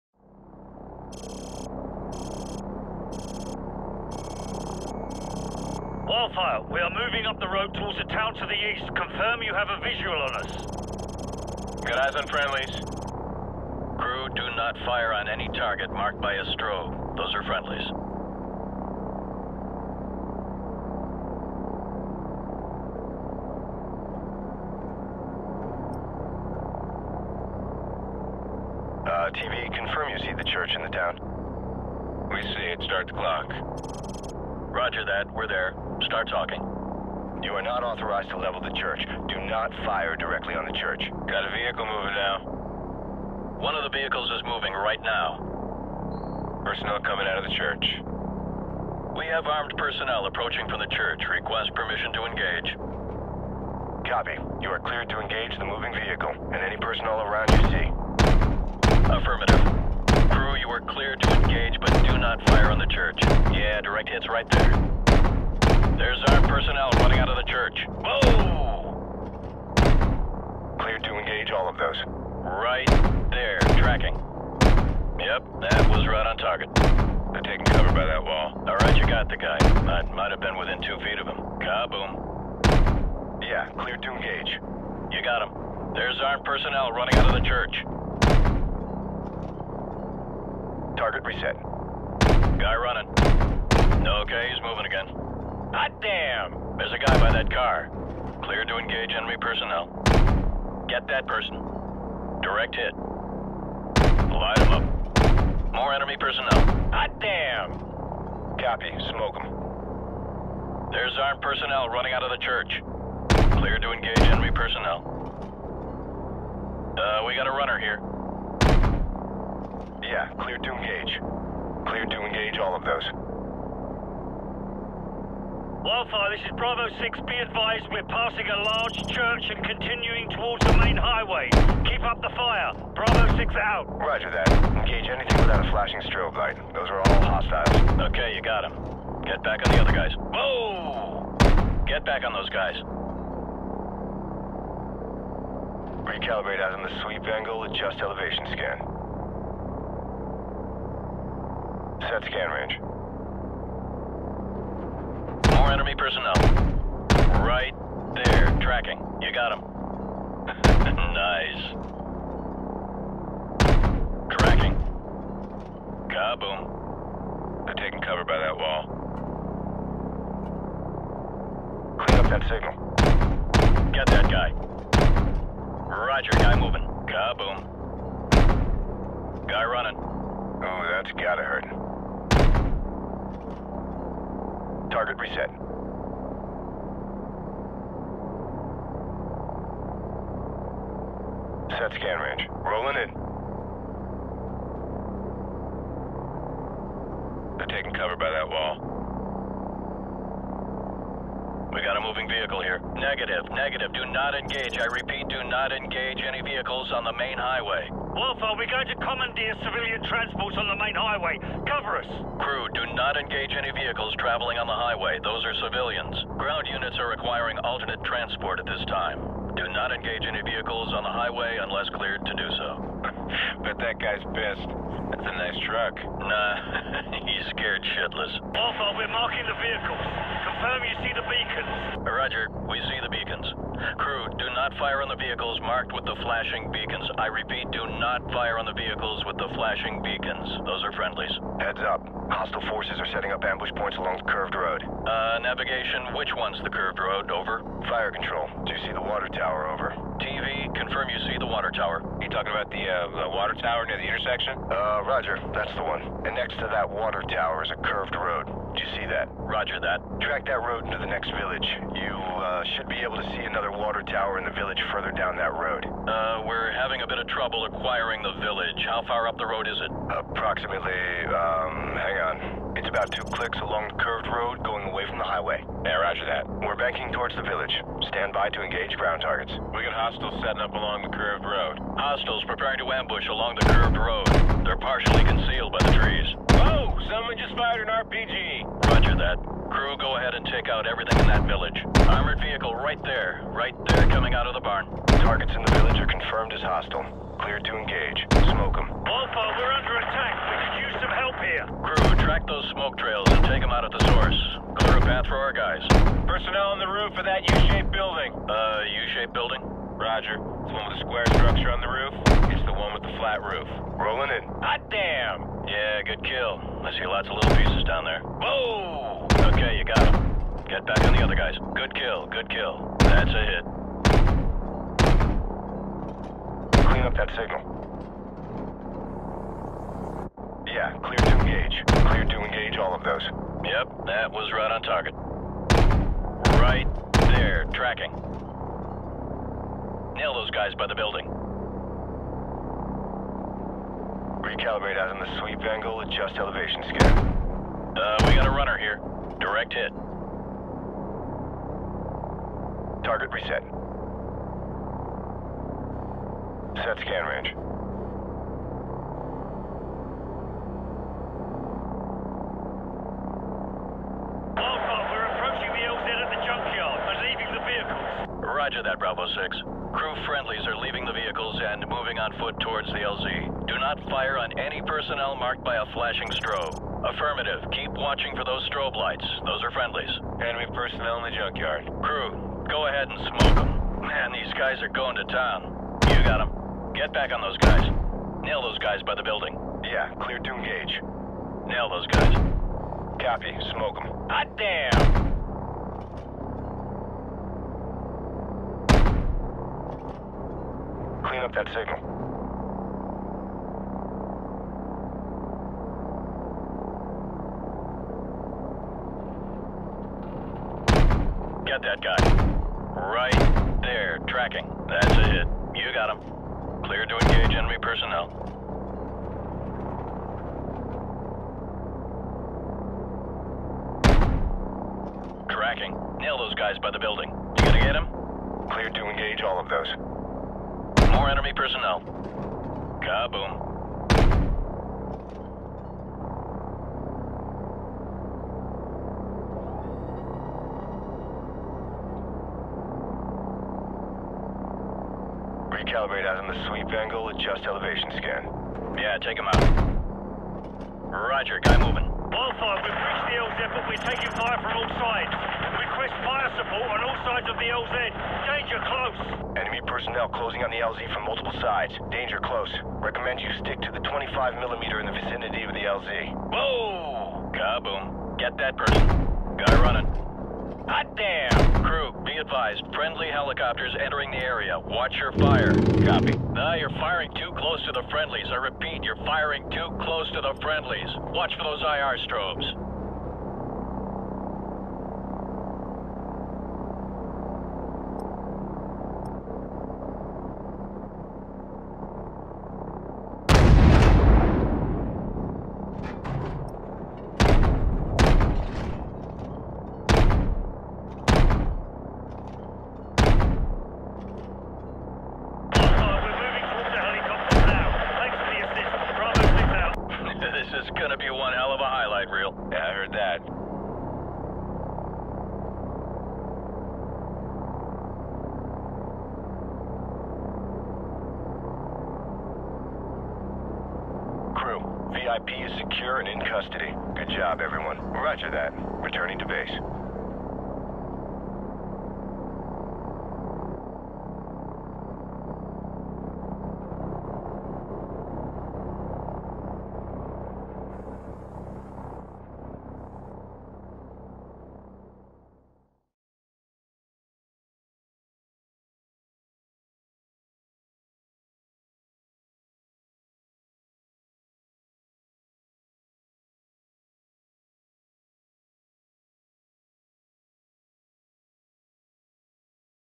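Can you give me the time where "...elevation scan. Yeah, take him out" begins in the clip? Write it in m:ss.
7:27.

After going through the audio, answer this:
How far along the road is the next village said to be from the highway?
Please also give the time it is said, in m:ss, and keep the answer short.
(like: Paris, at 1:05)
2 clicks, at 4:33.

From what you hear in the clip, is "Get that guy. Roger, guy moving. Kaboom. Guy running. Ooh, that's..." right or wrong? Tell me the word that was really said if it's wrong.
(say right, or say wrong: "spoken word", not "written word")
right.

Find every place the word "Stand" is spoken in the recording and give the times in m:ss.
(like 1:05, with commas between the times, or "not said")
4:38.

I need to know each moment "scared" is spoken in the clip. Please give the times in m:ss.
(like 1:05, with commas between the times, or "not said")
3:47.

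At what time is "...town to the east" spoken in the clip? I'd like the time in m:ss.
0:08.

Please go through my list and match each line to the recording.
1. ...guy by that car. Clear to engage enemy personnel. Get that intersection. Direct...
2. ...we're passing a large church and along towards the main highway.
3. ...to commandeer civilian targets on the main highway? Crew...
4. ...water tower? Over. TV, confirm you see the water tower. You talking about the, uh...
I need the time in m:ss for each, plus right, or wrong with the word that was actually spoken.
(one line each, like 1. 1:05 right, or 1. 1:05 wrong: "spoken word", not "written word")
1. 1:36 wrong: "person", not "intersection"
2. 2:07 wrong: "continuing", not "along"
3. 3:28 wrong: "transports", not "targets"
4. 4:09 right.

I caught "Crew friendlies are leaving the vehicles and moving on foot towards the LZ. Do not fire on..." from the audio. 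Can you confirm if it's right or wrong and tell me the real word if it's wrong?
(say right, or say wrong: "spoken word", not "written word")
right.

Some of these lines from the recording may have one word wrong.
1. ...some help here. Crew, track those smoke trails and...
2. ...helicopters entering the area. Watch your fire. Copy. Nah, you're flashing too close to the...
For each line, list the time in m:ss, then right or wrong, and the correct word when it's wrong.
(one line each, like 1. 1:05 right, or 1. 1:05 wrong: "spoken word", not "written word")
1. 5:01 right
2. 7:53 wrong: "firing", not "flashing".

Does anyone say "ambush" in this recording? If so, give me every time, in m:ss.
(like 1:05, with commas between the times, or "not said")
4:03, 4:42.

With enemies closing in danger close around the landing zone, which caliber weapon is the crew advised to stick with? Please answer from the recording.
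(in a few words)
25 millimeter.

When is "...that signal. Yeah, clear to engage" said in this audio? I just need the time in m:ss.
5:27.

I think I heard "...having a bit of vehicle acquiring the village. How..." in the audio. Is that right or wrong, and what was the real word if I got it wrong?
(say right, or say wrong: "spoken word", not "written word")
wrong: "trouble", not "vehicle".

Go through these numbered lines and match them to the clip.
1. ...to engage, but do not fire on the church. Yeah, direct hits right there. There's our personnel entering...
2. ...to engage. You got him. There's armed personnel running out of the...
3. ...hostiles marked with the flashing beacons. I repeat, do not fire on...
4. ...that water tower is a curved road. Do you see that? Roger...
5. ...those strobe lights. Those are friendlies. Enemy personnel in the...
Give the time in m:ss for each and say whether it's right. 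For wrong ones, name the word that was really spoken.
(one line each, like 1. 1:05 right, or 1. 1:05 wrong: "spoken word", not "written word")
1. 1:01 wrong: "running", not "entering"
2. 1:23 right
3. 3:55 wrong: "vehicles", not "hostiles"
4. 4:16 right
5. 6:18 right.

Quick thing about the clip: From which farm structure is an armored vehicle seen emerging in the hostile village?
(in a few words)
The barn.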